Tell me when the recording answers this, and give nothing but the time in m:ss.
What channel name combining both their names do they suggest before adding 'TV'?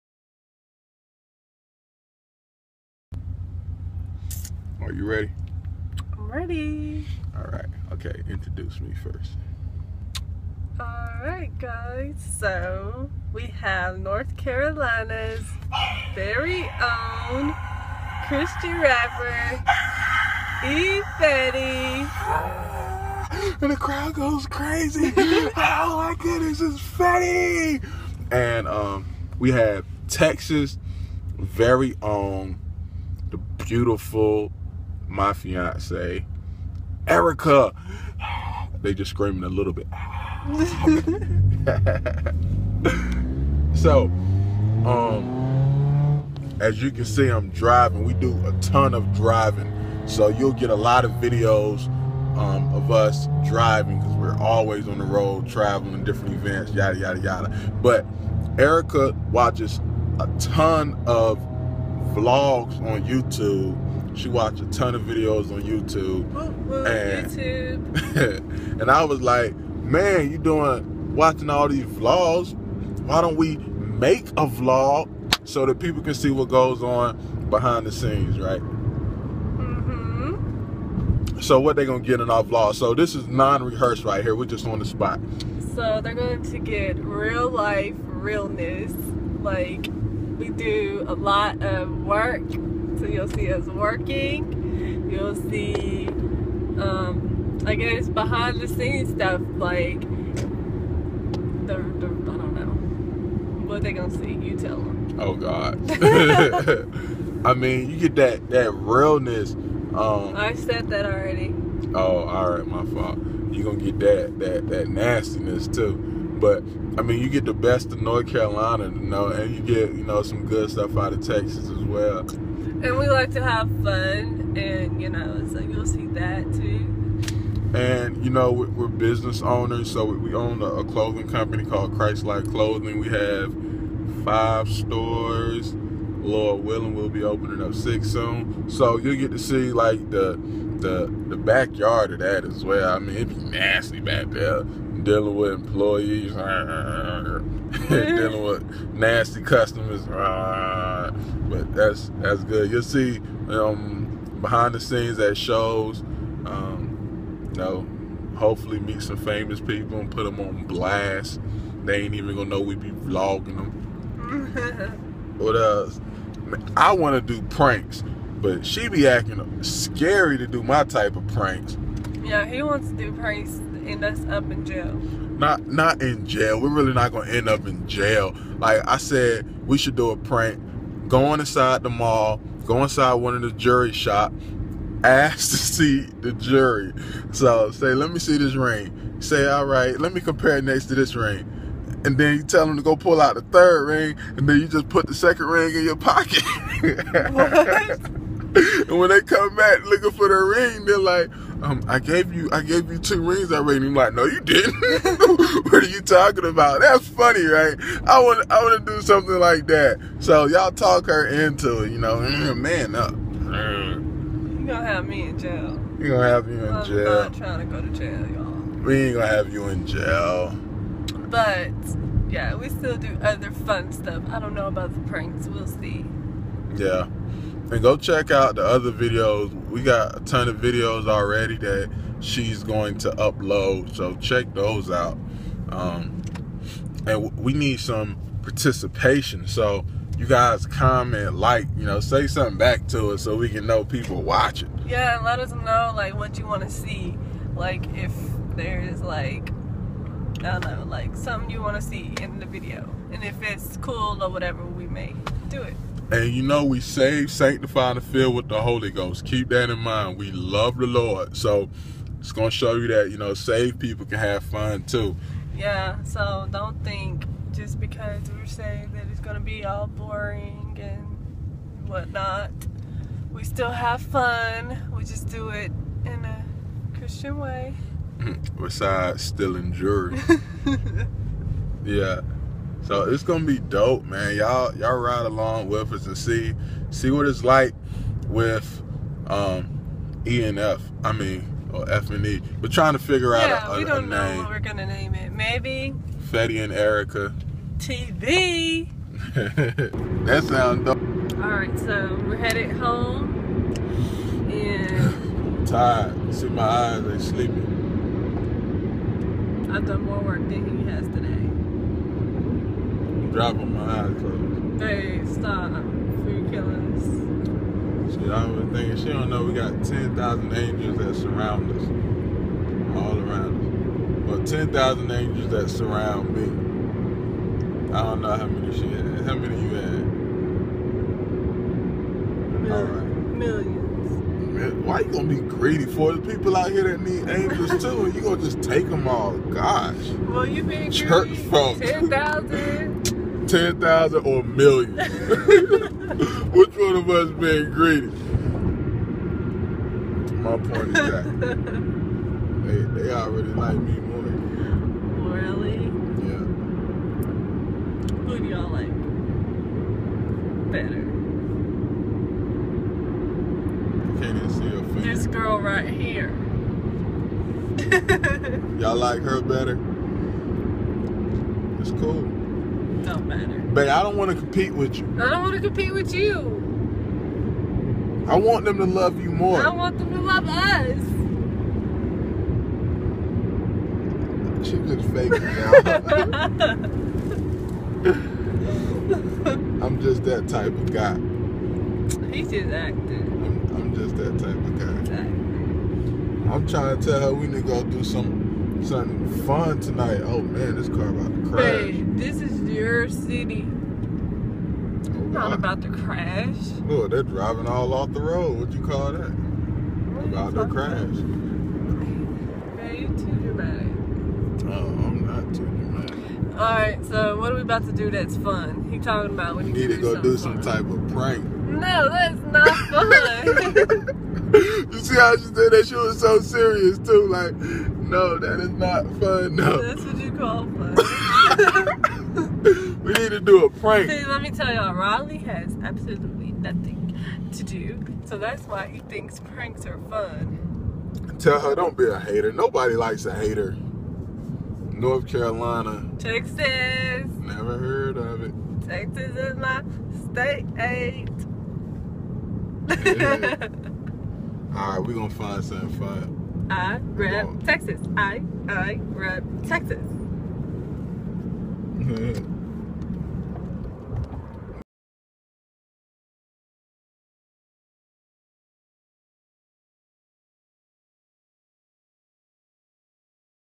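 4:56.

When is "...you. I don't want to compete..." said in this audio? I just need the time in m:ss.
6:14.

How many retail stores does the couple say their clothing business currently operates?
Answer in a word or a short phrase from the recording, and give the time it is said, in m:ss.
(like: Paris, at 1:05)
5, at 2:14.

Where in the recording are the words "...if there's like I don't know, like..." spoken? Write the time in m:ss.
4:07.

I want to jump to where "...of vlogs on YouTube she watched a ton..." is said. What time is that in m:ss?
1:01.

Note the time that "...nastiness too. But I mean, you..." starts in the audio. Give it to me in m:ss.
1:54.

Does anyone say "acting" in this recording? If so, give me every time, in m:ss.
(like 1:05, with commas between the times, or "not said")
2:49, 6:32.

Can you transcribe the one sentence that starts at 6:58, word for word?
He talking about when you need to go do some fun.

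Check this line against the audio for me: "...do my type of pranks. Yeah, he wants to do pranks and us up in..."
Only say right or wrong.
right.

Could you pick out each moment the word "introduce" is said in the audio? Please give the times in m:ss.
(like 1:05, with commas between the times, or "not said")
0:08.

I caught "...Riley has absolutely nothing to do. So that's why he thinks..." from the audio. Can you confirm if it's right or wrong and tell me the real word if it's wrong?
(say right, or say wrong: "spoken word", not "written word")
right.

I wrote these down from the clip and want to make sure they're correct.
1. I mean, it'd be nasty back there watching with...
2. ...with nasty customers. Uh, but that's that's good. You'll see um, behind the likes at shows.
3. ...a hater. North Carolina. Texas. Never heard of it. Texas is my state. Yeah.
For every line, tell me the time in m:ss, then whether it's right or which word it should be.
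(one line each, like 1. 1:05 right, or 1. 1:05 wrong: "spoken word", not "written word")
1. 2:22 wrong: "dealing", not "watching"
2. 2:28 wrong: "scenes", not "likes"
3. 7:23 right.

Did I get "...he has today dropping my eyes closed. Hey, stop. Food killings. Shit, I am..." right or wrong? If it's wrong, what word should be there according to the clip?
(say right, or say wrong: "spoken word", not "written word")
right.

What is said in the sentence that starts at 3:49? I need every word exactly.
We got a ton of videos already that she's going to upload, so check those out.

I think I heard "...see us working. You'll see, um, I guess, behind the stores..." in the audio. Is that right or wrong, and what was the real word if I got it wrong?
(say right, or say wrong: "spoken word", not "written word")
wrong: "scenes", not "stores".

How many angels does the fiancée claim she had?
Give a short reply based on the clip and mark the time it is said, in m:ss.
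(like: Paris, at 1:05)
Millions, at 5:33.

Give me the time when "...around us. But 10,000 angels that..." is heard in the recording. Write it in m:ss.
5:23.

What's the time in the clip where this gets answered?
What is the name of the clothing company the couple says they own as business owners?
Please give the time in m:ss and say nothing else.
2:11.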